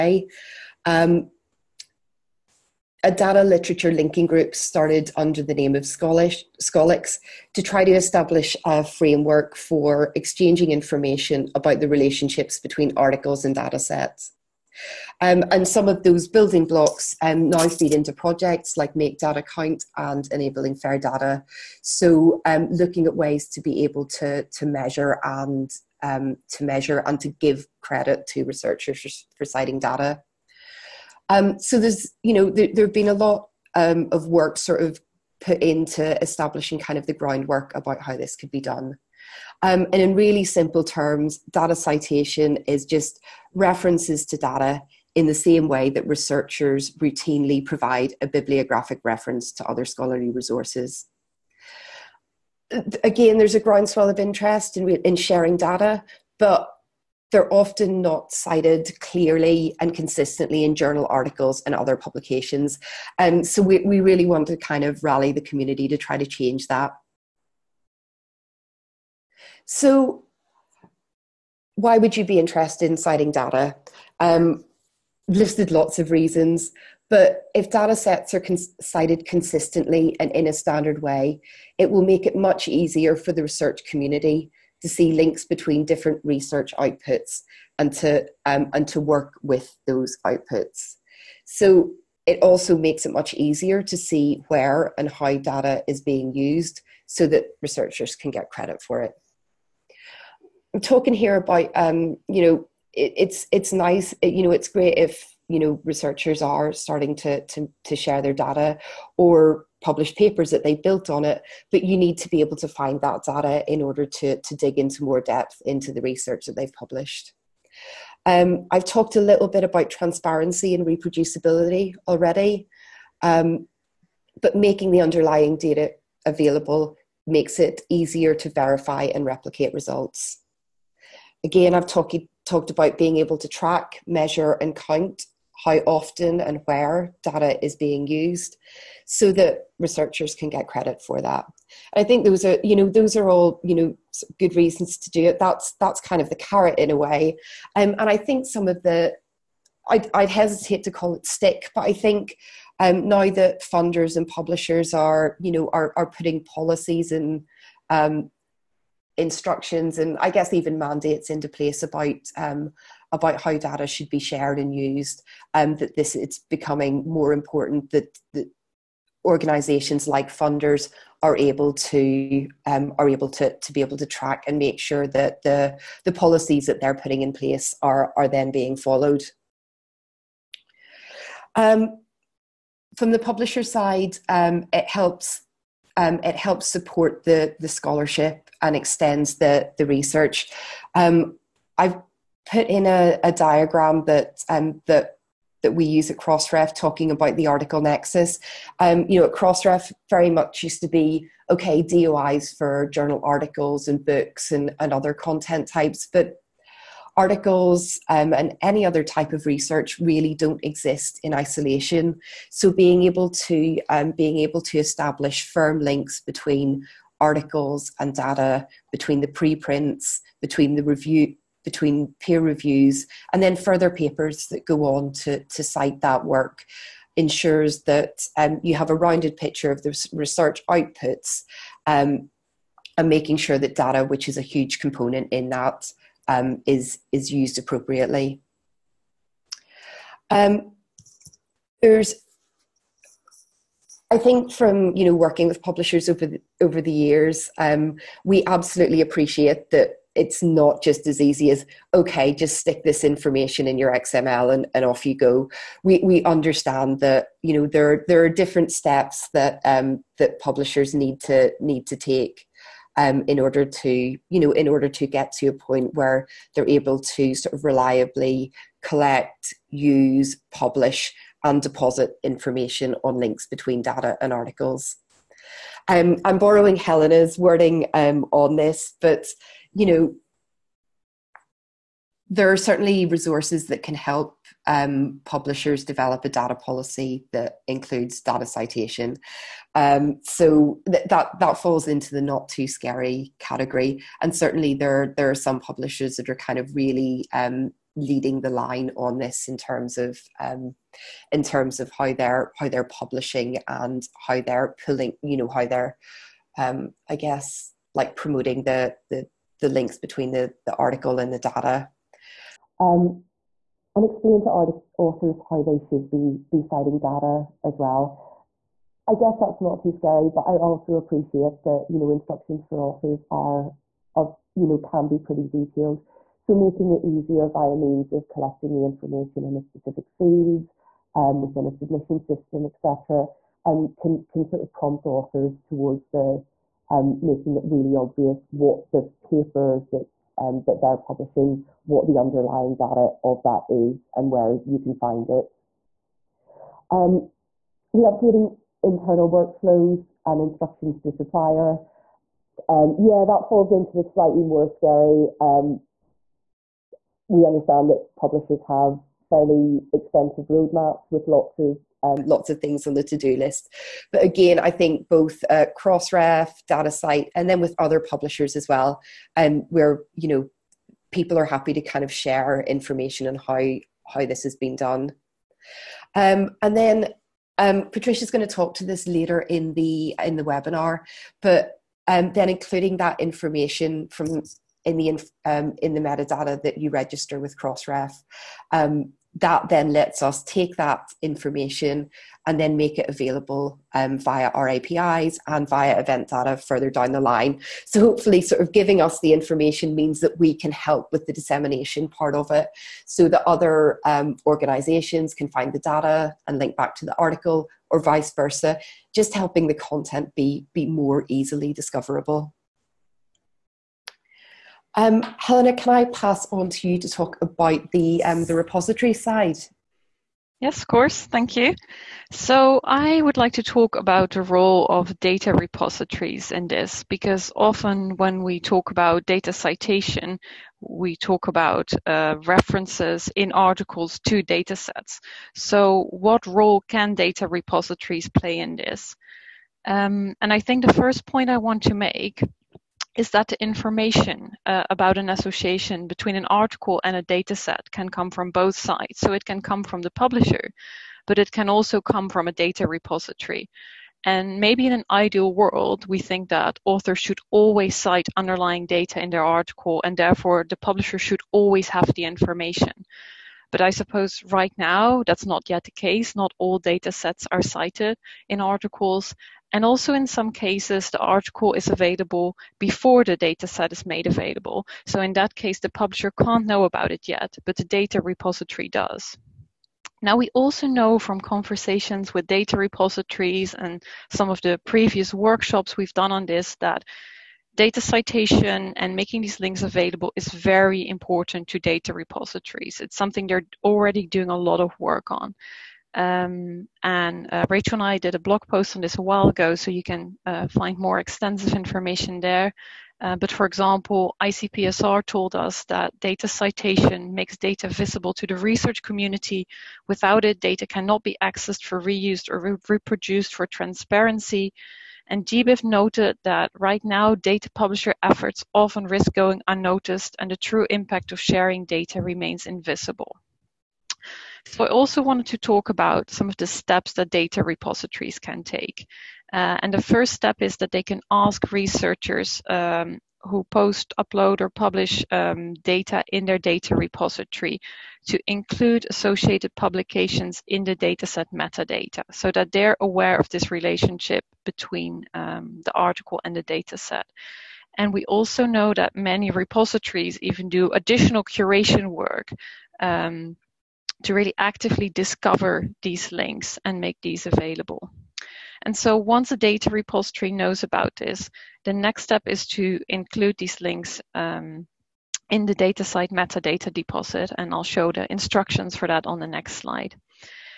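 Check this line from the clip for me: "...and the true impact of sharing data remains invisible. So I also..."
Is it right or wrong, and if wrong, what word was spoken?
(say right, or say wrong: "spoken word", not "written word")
right.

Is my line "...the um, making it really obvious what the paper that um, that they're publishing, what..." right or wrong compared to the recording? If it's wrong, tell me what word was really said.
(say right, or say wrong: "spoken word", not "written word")
right.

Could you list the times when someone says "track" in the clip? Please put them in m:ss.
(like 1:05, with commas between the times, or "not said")
2:13, 2:54.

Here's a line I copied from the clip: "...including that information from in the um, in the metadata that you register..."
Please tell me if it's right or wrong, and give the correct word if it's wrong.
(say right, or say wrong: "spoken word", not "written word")
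right.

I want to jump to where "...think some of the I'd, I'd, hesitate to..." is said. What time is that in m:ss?
2:28.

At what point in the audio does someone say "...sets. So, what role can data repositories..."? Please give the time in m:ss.
7:14.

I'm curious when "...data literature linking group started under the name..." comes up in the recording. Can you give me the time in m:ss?
0:03.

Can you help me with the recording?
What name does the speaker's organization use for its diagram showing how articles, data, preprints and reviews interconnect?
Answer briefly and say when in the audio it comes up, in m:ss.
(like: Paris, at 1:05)
article nexus, at 3:17.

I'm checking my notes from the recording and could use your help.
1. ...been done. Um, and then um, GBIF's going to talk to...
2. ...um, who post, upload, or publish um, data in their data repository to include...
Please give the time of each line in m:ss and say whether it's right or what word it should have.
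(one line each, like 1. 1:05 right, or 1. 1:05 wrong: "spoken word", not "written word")
1. 6:14 wrong: "Patricia", not "GBIF"
2. 8:52 right.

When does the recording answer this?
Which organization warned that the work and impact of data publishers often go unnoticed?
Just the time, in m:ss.
8:35.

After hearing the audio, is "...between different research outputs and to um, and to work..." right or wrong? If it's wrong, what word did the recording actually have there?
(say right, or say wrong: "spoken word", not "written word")
right.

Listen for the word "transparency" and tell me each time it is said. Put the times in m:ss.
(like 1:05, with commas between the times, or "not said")
1:59, 8:33.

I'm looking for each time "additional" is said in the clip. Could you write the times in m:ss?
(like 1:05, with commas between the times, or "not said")
9:10.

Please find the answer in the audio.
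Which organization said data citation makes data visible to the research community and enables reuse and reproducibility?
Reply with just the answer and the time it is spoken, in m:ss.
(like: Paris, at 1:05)
ICPSR, at 8:24.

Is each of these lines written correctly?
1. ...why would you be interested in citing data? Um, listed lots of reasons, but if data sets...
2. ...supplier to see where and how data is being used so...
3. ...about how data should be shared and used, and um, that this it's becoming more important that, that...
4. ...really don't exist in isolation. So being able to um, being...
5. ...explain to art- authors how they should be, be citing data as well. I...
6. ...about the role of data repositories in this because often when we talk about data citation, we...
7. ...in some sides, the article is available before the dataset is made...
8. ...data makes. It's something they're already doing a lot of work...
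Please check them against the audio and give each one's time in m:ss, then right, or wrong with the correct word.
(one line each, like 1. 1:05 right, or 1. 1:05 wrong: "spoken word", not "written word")
1. 1:11 right
2. 1:33 wrong: "easier", not "supplier"
3. 2:43 right
4. 3:29 right
5. 5:14 right
6. 7:03 right
7. 7:50 wrong: "cases", not "sides"
8. 8:11 wrong: "repositories", not "makes".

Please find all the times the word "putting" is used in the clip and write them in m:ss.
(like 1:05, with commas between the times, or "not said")
2:36, 2:56.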